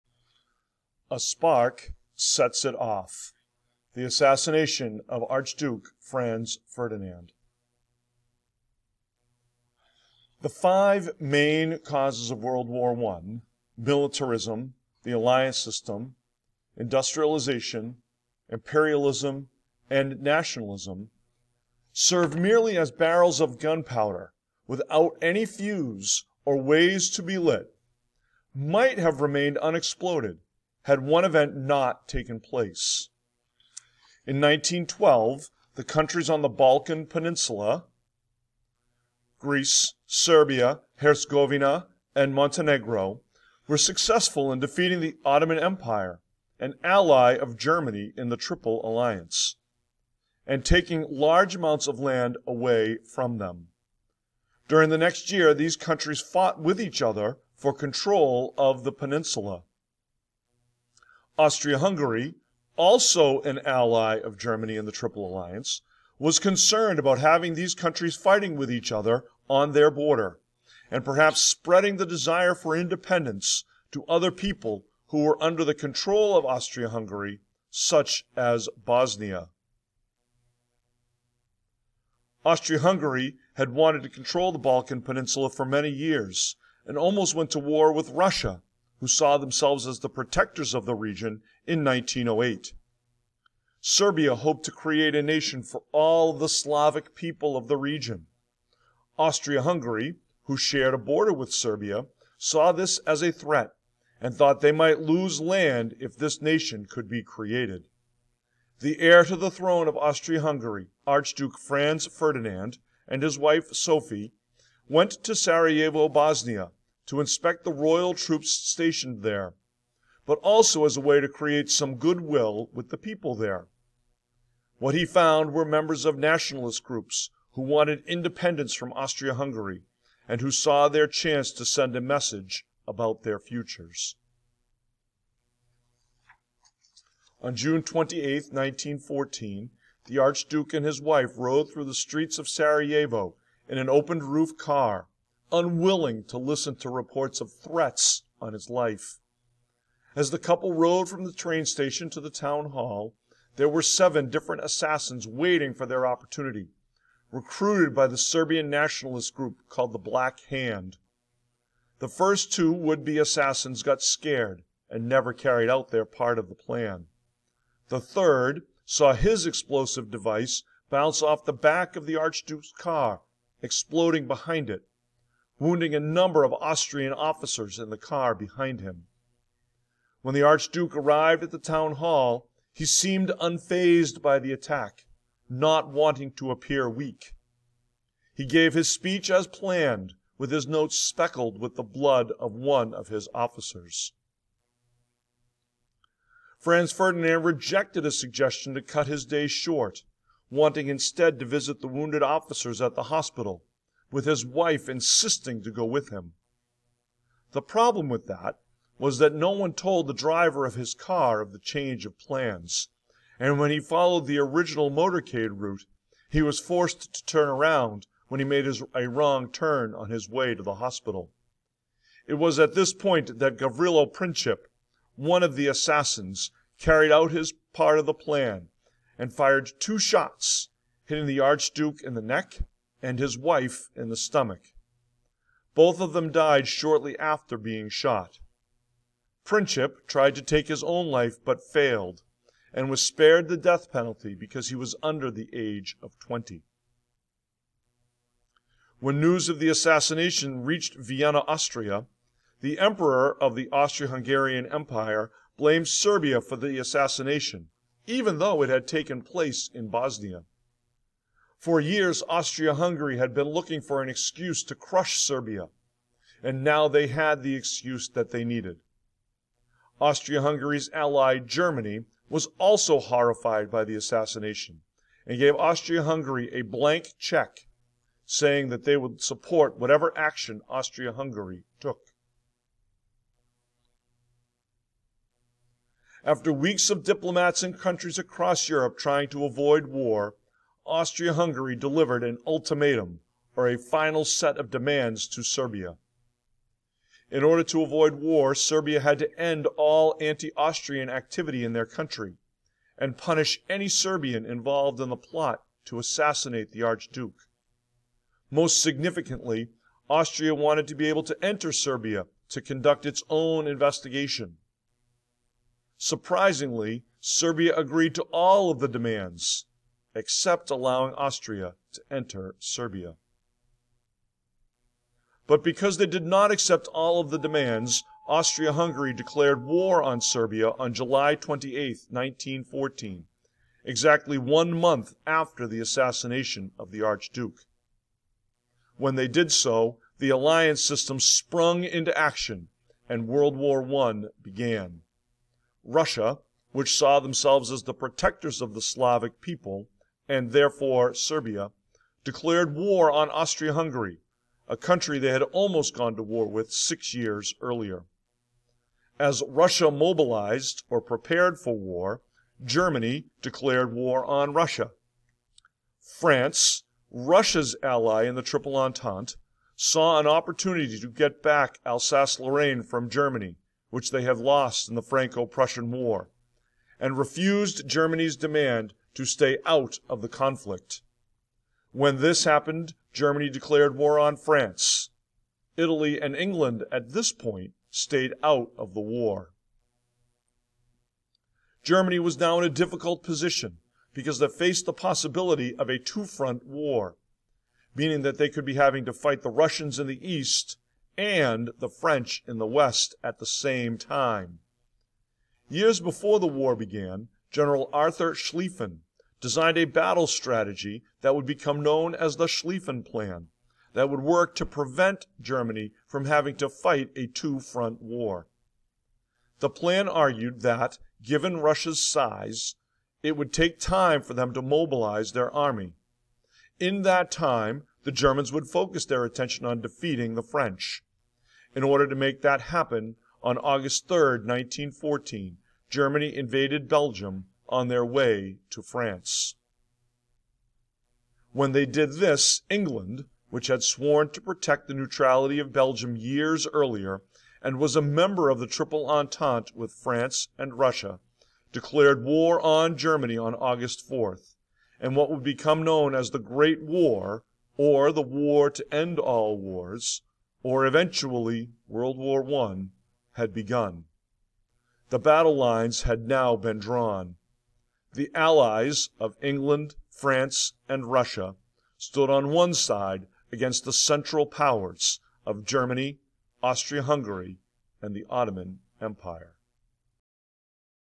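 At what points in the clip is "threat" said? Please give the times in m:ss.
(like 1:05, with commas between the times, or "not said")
1:43, 2:27.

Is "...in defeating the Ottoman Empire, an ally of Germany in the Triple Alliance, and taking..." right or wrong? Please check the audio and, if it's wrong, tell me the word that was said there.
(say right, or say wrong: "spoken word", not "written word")
right.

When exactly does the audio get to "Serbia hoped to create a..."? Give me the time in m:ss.
1:33.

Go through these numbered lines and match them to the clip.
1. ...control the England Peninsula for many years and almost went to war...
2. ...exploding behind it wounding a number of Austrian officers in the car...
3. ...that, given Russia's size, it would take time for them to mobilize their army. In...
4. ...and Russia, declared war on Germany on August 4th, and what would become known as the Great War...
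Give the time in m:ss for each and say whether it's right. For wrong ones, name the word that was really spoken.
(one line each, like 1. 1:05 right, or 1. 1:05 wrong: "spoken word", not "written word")
1. 1:24 wrong: "Balkan", not "England"
2. 2:53 right
3. 7:00 right
4. 7:30 right.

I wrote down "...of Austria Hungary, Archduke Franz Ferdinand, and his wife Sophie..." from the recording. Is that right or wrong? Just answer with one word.
right.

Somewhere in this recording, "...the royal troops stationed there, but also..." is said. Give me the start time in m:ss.
1:57.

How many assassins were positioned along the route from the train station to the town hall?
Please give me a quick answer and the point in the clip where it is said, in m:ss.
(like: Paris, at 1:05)
7, at 2:33.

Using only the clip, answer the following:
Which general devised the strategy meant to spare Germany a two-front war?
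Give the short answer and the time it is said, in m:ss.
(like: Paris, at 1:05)
Arthur Schlieffen, at 6:47.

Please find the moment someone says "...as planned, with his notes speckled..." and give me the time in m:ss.
3:09.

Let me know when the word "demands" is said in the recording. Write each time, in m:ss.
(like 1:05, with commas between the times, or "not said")
4:54, 5:18, 5:27, 6:18.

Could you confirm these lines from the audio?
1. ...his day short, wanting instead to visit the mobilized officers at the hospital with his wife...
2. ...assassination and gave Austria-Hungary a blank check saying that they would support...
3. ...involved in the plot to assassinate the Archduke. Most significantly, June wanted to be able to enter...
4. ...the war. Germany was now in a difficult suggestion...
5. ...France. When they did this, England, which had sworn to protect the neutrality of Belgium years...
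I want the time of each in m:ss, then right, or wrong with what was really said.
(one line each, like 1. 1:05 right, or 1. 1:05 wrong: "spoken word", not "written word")
1. 3:19 wrong: "wounded", not "mobilized"
2. 4:33 right
3. 5:04 wrong: "Austria", not "June"
4. 6:28 wrong: "position", not "suggestion"
5. 7:18 right.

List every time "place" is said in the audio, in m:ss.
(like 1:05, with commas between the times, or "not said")
0:32, 4:19.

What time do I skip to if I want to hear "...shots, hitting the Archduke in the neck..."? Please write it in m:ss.
3:49.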